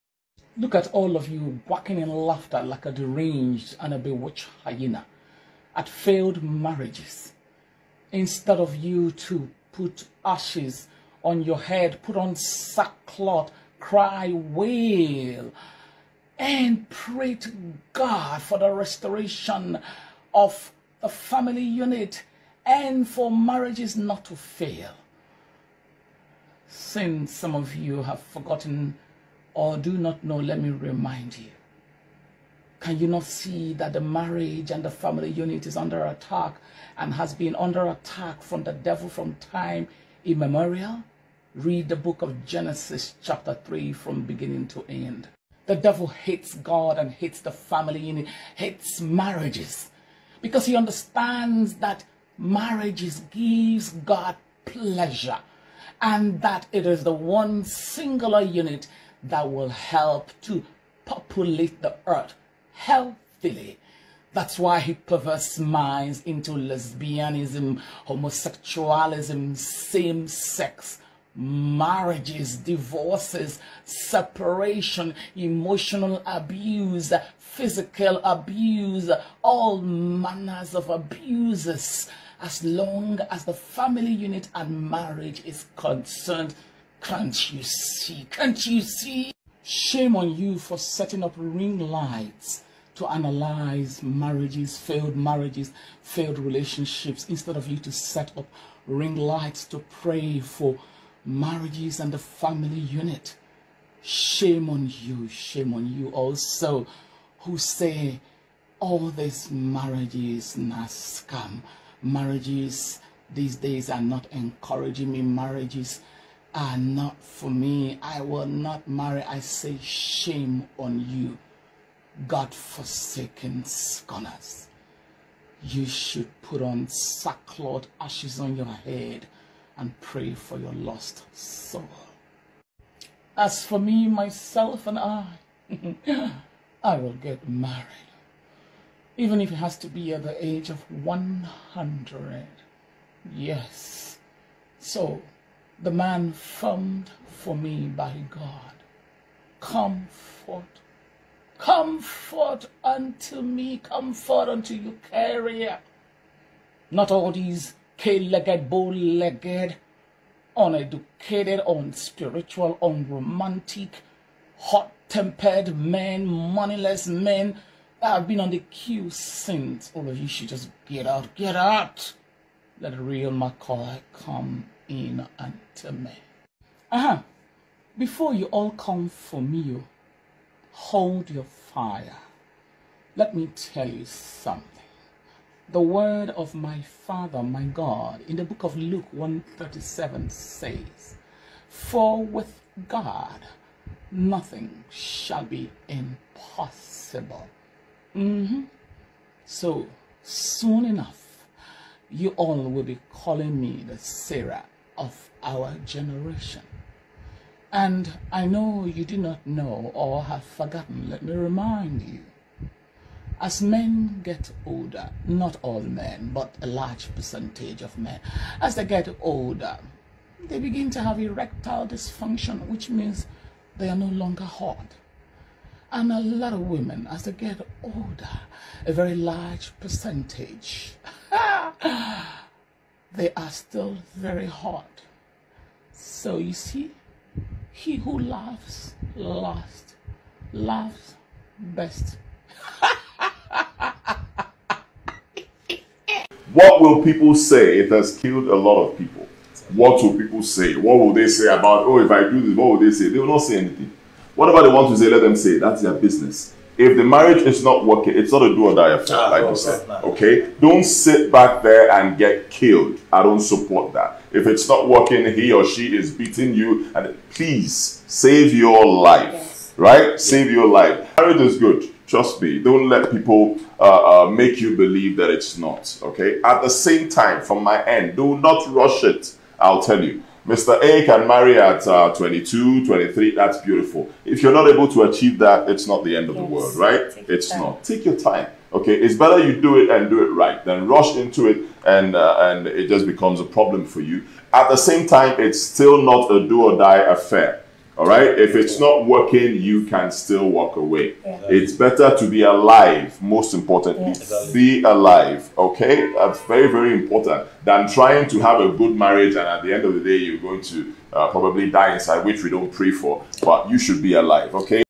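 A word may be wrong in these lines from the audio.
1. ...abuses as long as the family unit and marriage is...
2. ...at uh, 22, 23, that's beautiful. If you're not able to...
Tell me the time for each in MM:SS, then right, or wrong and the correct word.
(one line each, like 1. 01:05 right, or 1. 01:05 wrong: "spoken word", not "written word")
1. 01:20 right
2. 04:41 right.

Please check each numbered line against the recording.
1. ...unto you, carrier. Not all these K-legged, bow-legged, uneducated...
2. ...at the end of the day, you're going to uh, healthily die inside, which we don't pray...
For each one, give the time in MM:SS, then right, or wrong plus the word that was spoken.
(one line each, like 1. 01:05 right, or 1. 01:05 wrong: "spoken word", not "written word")
1. 02:34 right
2. 05:09 wrong: "probably", not "healthily".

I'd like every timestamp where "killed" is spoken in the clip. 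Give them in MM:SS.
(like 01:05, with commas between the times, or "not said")
04:08, 04:22.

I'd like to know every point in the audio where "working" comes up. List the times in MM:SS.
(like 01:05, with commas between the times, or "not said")
04:17, 04:24, 04:59.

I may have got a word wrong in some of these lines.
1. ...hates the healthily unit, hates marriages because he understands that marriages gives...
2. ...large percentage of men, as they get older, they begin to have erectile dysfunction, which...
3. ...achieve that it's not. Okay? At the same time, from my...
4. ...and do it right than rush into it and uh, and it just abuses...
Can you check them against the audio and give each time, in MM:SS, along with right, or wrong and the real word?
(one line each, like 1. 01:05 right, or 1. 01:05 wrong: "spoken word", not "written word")
1. 00:47 wrong: "family", not "healthily"
2. 03:36 right
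3. 04:34 wrong: "believe", not "achieve"
4. 04:49 wrong: "becomes", not "abuses".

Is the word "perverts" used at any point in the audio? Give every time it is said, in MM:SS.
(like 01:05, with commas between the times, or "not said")
01:04.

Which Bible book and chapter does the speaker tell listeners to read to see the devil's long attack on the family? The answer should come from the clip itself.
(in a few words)
Genesis chapter 3.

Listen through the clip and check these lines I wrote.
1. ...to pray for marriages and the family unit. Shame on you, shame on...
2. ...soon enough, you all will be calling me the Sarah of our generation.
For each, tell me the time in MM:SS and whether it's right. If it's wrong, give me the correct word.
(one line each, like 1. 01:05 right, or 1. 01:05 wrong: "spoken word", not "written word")
1. 01:39 right
2. 03:20 right.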